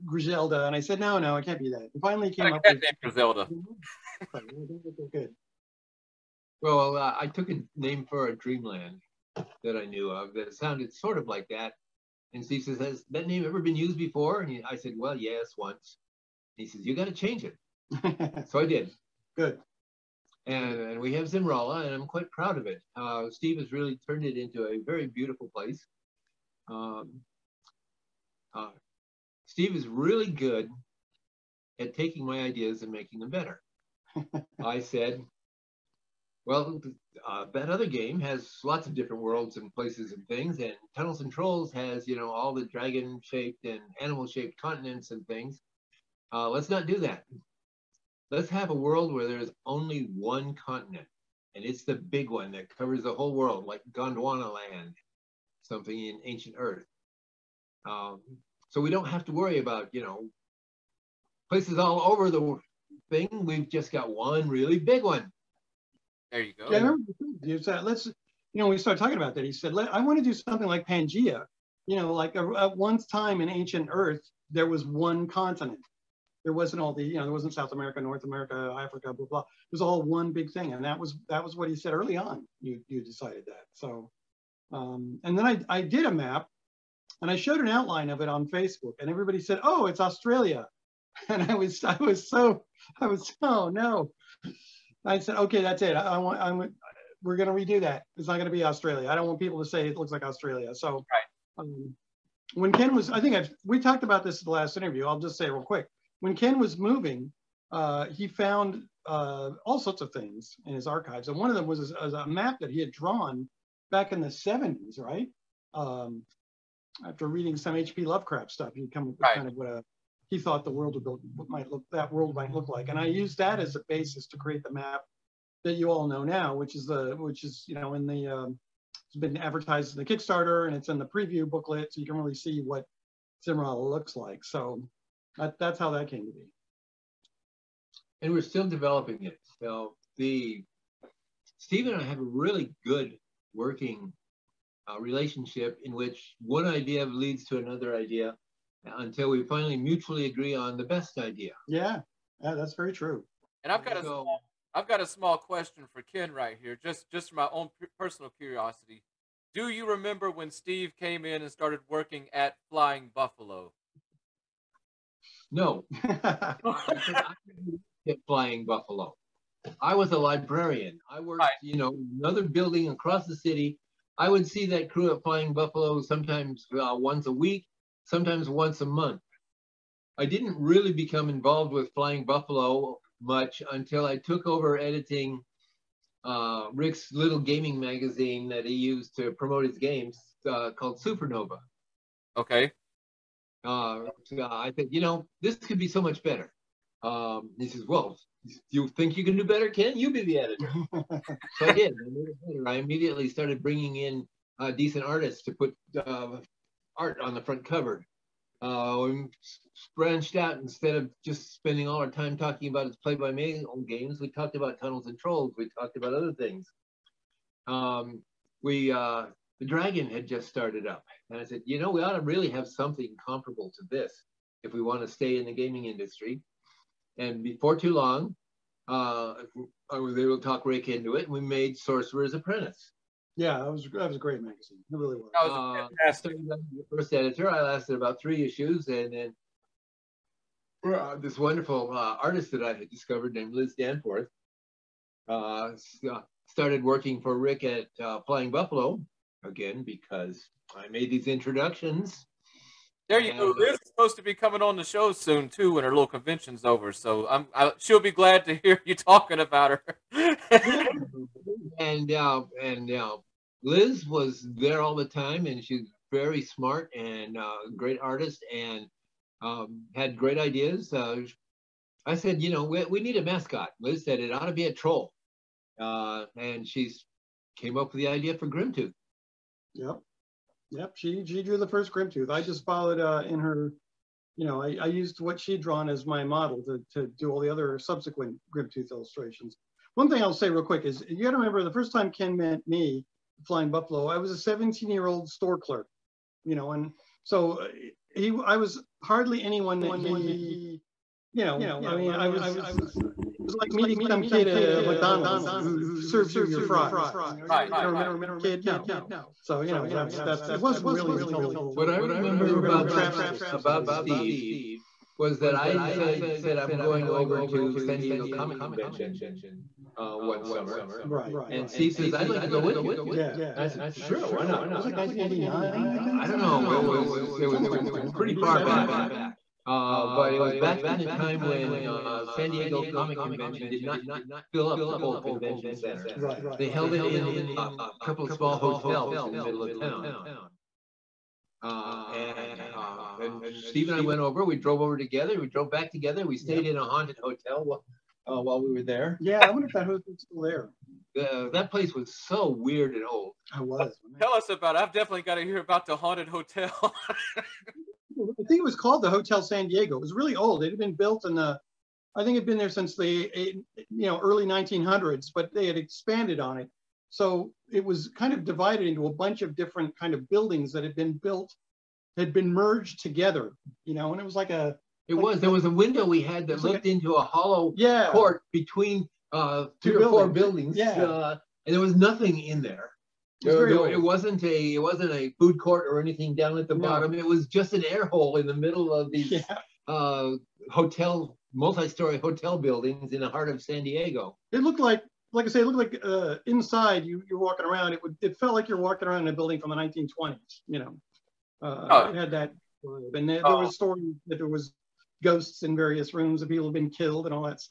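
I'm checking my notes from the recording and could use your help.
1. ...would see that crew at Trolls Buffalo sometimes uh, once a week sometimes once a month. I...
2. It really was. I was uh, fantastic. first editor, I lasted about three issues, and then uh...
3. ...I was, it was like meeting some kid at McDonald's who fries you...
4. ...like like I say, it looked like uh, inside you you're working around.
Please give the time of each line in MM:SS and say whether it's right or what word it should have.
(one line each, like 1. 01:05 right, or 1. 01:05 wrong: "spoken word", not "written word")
1. 02:54 wrong: "Flying", not "Trolls"
2. 03:54 right
3. 05:02 wrong: "serves", not "fries"
4. 06:34 wrong: "walking", not "working".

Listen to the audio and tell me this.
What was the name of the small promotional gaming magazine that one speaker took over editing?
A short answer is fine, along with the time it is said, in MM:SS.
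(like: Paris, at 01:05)
Supernova, at 03:11.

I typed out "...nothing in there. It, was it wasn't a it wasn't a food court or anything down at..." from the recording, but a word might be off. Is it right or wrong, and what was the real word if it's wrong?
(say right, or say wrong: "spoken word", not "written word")
right.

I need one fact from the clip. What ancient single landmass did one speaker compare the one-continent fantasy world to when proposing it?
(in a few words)
Gondwana Land.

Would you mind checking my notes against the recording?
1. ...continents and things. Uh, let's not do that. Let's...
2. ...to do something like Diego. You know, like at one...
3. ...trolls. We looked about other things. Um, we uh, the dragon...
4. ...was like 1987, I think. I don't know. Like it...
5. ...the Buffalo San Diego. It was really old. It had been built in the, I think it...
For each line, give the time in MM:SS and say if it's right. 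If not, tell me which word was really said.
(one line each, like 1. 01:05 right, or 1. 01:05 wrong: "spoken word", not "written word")
1. 00:44 right
2. 01:10 wrong: "Pangea", not "Diego"
3. 03:35 wrong: "talked", not "looked"
4. 05:24 wrong: "1989", not "1987"
5. 05:59 wrong: "Hotel", not "Buffalo".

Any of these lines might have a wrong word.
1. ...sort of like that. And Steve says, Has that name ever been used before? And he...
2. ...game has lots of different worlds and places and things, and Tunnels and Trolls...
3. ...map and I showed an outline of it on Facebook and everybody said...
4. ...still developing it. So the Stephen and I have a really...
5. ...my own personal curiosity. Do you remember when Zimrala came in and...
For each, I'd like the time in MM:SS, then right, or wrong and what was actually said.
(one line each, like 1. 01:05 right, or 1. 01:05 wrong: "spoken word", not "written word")
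1. 00:10 right
2. 00:37 right
3. 01:26 right
4. 02:18 right
5. 02:37 wrong: "Steve", not "Zimrala".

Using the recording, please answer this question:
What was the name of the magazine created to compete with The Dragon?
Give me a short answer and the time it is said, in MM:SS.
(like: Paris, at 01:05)
Sorcerer's Apprentice, at 03:51.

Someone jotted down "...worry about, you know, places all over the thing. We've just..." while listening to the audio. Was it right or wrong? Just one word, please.
right.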